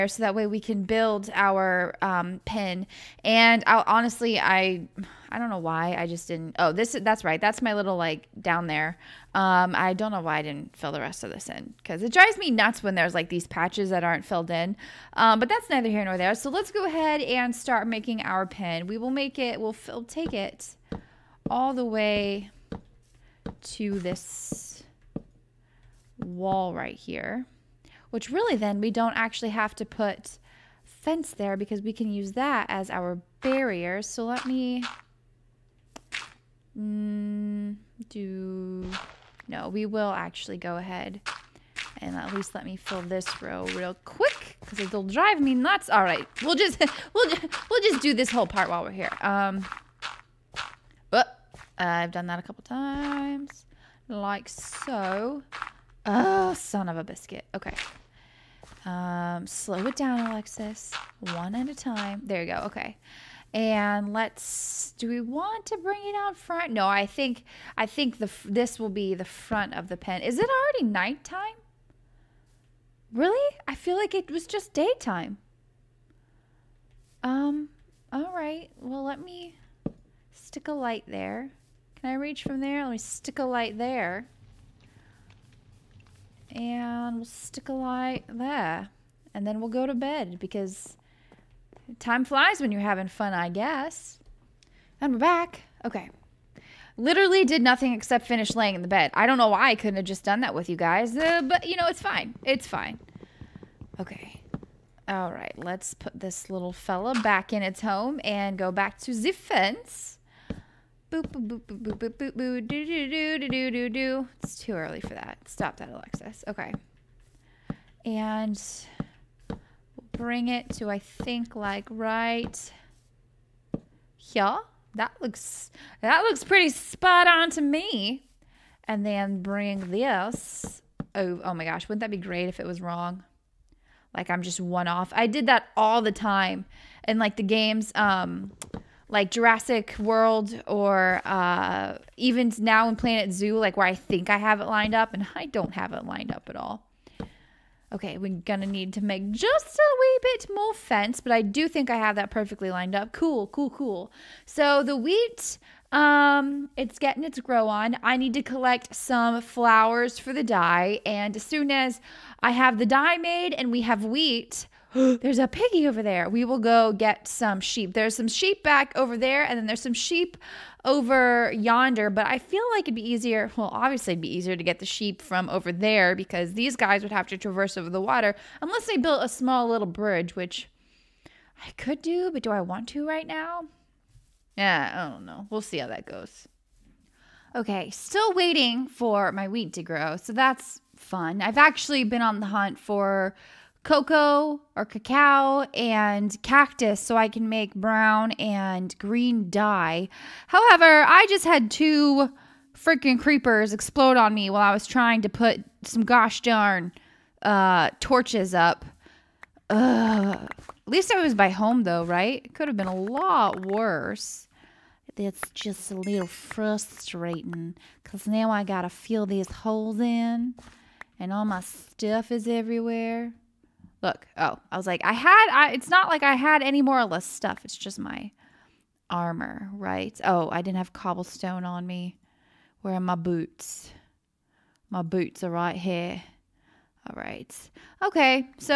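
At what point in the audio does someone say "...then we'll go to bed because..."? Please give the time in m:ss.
1:29.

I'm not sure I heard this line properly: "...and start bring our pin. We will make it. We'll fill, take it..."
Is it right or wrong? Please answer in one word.
wrong.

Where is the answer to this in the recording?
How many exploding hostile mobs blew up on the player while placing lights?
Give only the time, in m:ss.
3:21.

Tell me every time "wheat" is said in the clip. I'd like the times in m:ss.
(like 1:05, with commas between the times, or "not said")
2:34, 2:44, 3:09.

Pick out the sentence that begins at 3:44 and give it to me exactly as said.
Look, oh, I was like, I had, I, it's not like I had any more or less stuff.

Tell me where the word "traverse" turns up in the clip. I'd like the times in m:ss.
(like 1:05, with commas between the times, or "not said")
2:57.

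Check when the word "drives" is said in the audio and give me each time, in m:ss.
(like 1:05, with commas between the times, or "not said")
0:12, 0:45.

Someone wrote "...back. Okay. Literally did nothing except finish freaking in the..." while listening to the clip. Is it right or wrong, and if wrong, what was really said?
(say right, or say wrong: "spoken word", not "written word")
wrong: "laying", not "freaking".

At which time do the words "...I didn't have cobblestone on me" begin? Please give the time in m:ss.
3:50.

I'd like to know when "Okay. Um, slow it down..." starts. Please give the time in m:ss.
0:57.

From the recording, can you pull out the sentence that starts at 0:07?
That's my little like down there.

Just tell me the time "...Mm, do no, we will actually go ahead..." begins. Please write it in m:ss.
0:36.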